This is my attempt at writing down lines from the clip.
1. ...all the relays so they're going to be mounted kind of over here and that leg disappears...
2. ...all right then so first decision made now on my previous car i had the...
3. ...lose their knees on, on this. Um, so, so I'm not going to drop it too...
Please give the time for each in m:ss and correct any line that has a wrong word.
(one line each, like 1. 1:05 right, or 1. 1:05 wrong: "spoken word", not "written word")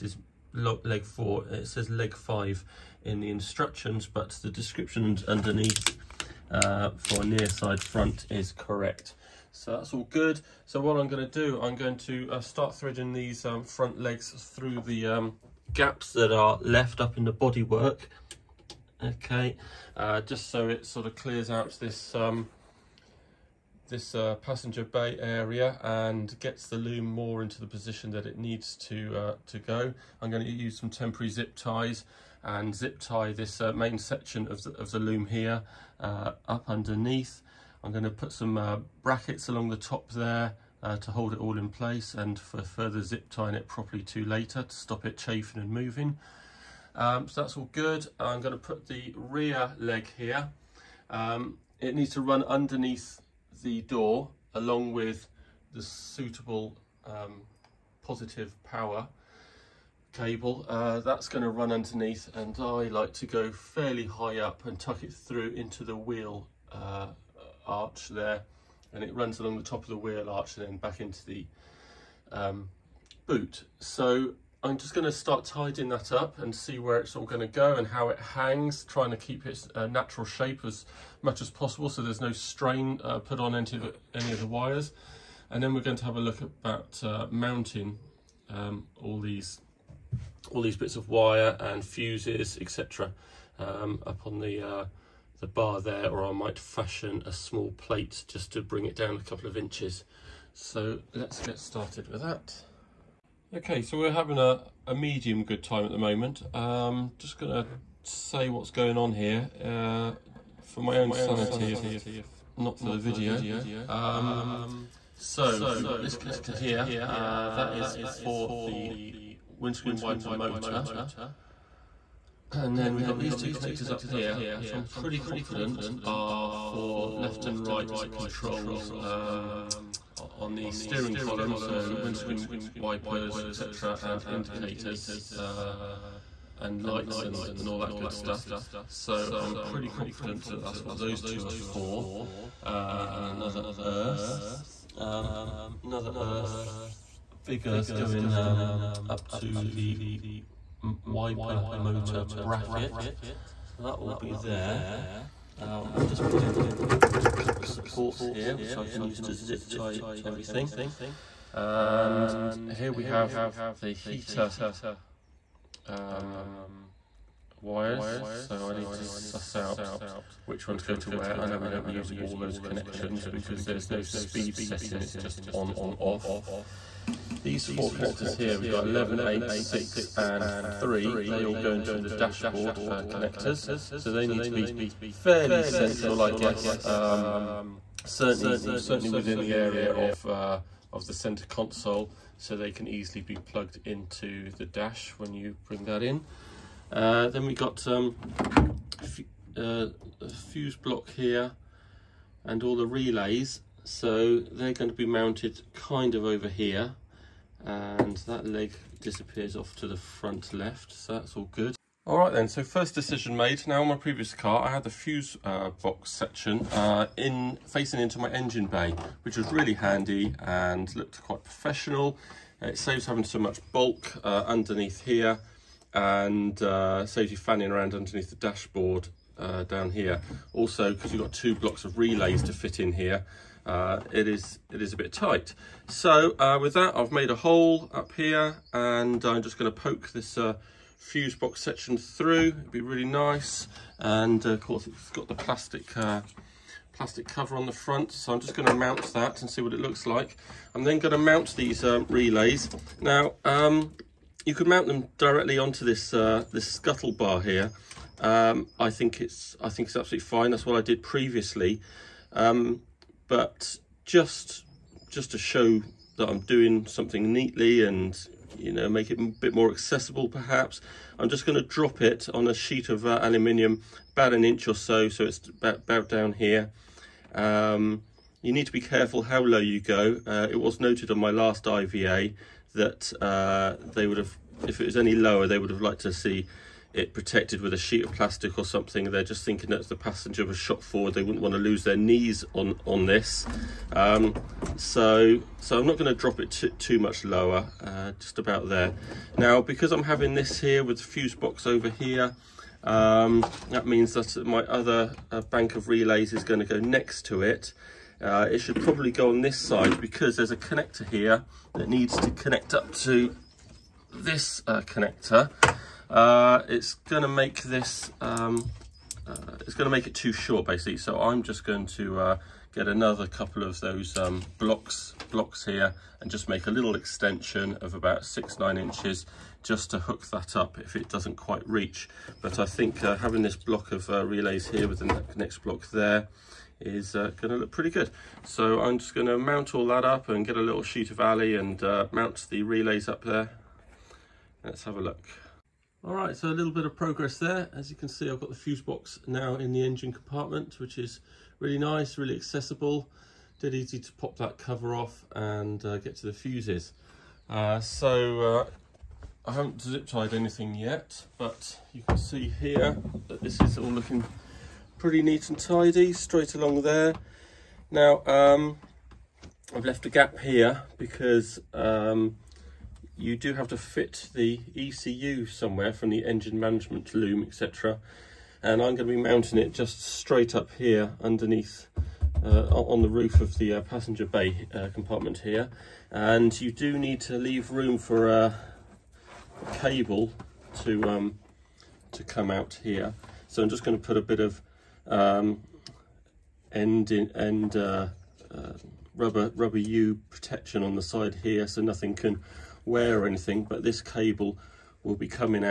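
1. 3:22 right
2. 3:32 right
3. 4:51 right.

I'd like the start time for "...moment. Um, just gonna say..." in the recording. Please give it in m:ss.
1:45.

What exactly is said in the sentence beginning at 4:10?
I'm then going to mount these uh, relays.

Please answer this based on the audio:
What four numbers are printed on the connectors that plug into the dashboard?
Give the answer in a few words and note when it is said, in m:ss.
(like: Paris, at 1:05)
11, 8, 6 and 3, at 2:58.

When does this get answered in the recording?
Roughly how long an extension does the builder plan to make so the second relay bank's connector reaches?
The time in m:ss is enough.
5:28.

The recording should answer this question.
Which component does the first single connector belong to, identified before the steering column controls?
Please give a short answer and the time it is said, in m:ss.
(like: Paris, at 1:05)
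Windscreen wiper motor, at 1:59.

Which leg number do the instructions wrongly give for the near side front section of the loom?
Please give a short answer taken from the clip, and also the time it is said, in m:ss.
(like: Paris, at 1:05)
Leg 5, at 0:01.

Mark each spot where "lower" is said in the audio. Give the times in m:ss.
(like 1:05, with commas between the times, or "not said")
4:45, 4:57.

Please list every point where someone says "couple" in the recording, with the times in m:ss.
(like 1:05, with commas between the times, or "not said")
1:39, 2:37, 5:23.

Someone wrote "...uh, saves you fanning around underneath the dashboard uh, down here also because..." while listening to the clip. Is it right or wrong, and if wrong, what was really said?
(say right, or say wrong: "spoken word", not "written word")
right.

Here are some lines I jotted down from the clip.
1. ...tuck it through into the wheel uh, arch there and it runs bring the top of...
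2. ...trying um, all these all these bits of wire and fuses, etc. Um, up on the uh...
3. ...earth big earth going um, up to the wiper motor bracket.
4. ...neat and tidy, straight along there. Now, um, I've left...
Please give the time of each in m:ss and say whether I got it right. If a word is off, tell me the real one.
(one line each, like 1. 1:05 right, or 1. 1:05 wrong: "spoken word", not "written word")
1. 1:04 wrong: "along", not "bring"
2. 1:27 wrong: "mounting", not "trying"
3. 2:26 right
4. 6:05 right.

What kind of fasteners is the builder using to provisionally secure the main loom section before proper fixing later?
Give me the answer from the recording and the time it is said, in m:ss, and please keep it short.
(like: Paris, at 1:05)
Temporary zip ties, at 0:30.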